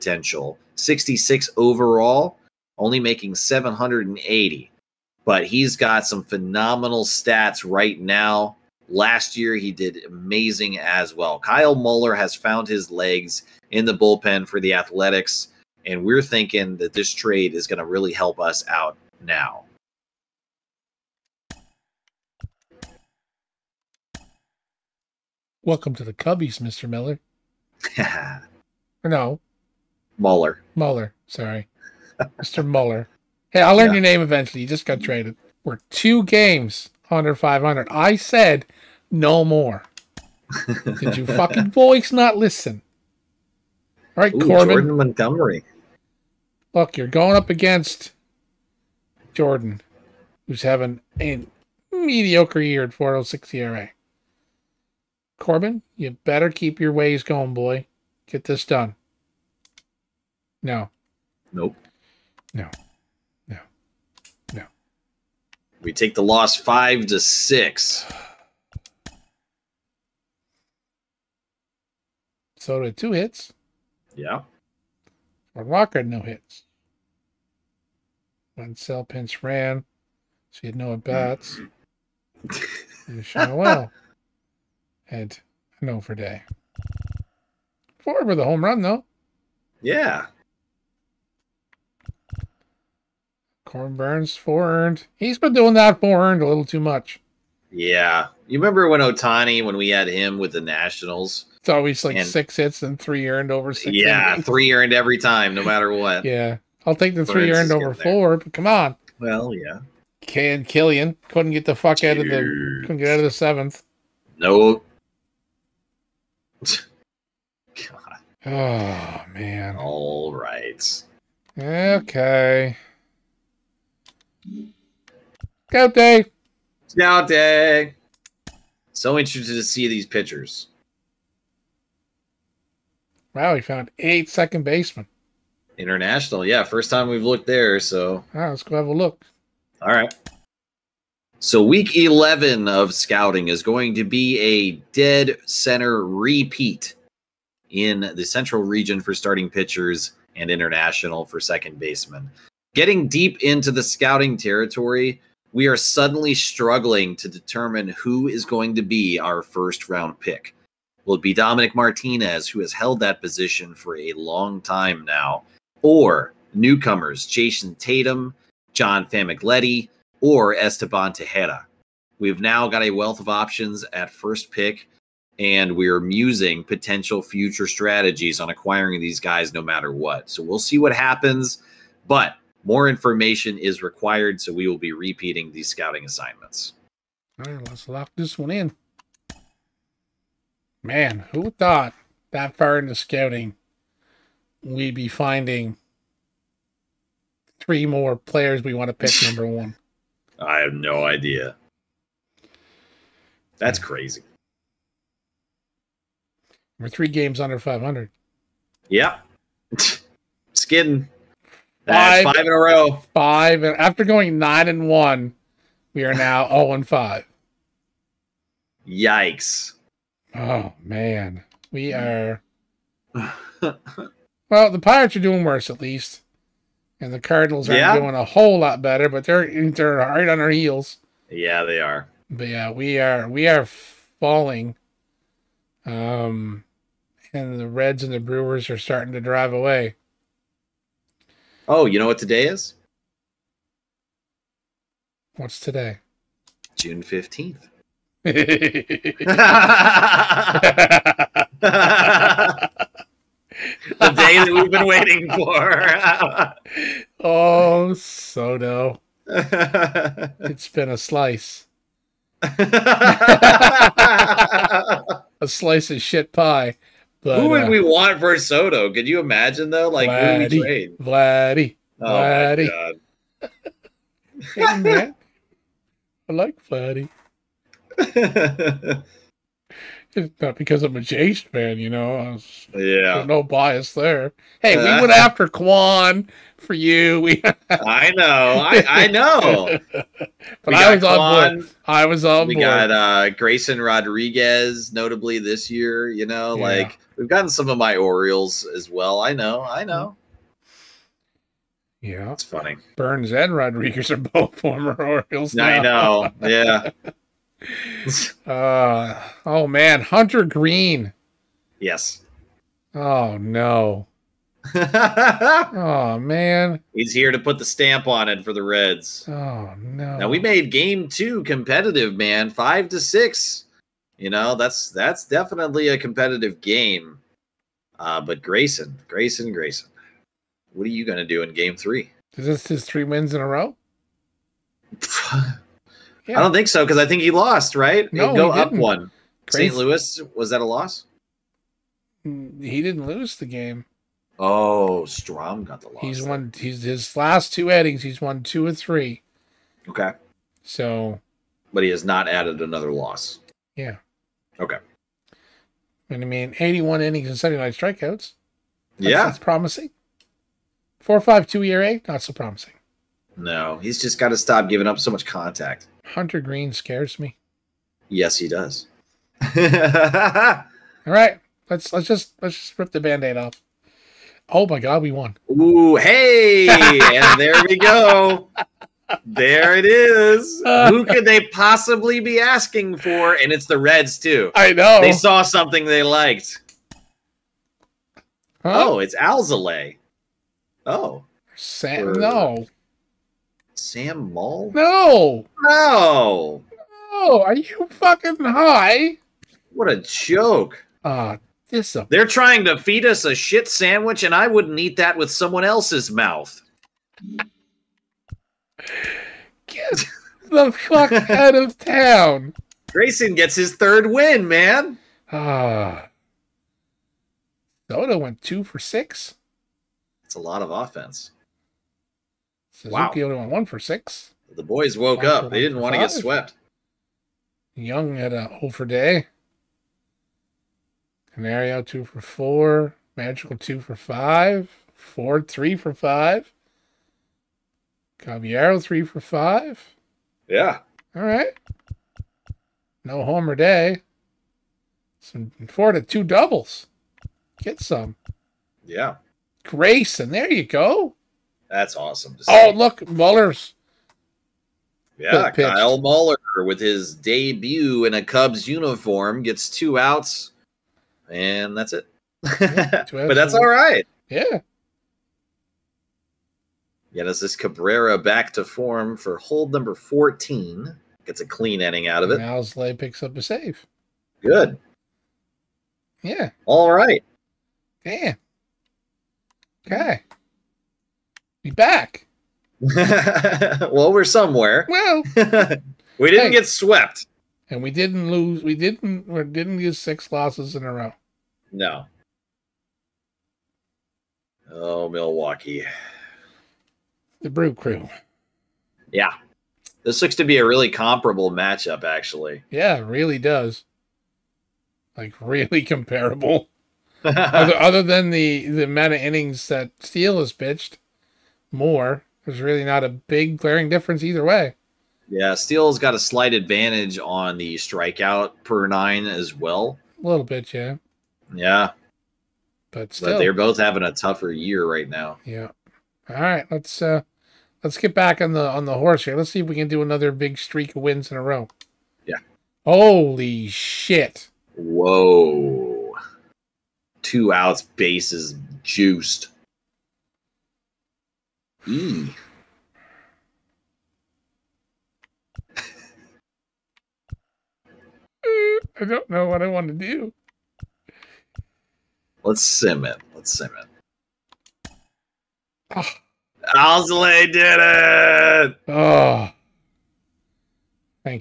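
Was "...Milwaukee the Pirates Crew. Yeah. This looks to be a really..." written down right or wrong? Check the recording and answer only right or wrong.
wrong.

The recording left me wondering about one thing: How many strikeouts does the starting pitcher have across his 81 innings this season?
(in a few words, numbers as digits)
79.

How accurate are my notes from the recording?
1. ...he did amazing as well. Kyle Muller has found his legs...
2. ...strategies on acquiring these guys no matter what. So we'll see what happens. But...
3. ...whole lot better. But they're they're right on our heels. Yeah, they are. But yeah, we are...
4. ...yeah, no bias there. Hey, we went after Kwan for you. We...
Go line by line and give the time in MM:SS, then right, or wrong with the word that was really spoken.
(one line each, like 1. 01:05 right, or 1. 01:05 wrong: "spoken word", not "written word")
1. 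00:09 right
2. 02:57 right
3. 03:48 right
4. 04:42 right.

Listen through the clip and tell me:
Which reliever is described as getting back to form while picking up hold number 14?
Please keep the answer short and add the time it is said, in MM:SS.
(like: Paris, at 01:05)
Cabrera, at 07:47.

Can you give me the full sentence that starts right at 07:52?
Now Slay picks up a save.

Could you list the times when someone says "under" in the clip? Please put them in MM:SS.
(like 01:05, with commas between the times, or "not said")
00:37, 03:27.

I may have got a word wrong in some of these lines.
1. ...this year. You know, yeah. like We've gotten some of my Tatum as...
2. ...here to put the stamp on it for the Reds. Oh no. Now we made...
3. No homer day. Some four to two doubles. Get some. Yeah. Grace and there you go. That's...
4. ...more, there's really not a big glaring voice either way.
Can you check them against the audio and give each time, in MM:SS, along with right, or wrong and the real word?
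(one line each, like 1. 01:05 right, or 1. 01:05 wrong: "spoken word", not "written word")
1. 04:55 wrong: "Orioles", not "Tatum"
2. 05:17 right
3. 07:23 right
4. 08:31 wrong: "difference", not "voice".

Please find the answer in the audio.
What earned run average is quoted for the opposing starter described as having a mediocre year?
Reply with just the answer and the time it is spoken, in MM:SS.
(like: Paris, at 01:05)
4.06, at 00:52.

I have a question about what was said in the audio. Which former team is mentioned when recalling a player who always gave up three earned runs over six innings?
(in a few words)
Nationals.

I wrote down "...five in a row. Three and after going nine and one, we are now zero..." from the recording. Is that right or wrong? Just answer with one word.
wrong.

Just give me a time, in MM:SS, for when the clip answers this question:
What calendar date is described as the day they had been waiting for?
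04:06.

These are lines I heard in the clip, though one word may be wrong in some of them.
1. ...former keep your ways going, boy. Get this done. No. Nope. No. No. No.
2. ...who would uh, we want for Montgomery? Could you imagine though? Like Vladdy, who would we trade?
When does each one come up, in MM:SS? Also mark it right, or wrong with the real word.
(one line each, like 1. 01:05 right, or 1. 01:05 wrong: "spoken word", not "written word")
1. 00:56 wrong: "better", not "former"
2. 04:27 wrong: "Soto", not "Montgomery".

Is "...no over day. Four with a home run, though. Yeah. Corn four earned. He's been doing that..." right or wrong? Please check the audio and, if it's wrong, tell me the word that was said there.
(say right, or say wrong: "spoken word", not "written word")
right.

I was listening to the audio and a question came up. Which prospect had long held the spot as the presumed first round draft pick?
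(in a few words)
Dominic Martinez.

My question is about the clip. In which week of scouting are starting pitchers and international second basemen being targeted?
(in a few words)
Week 11.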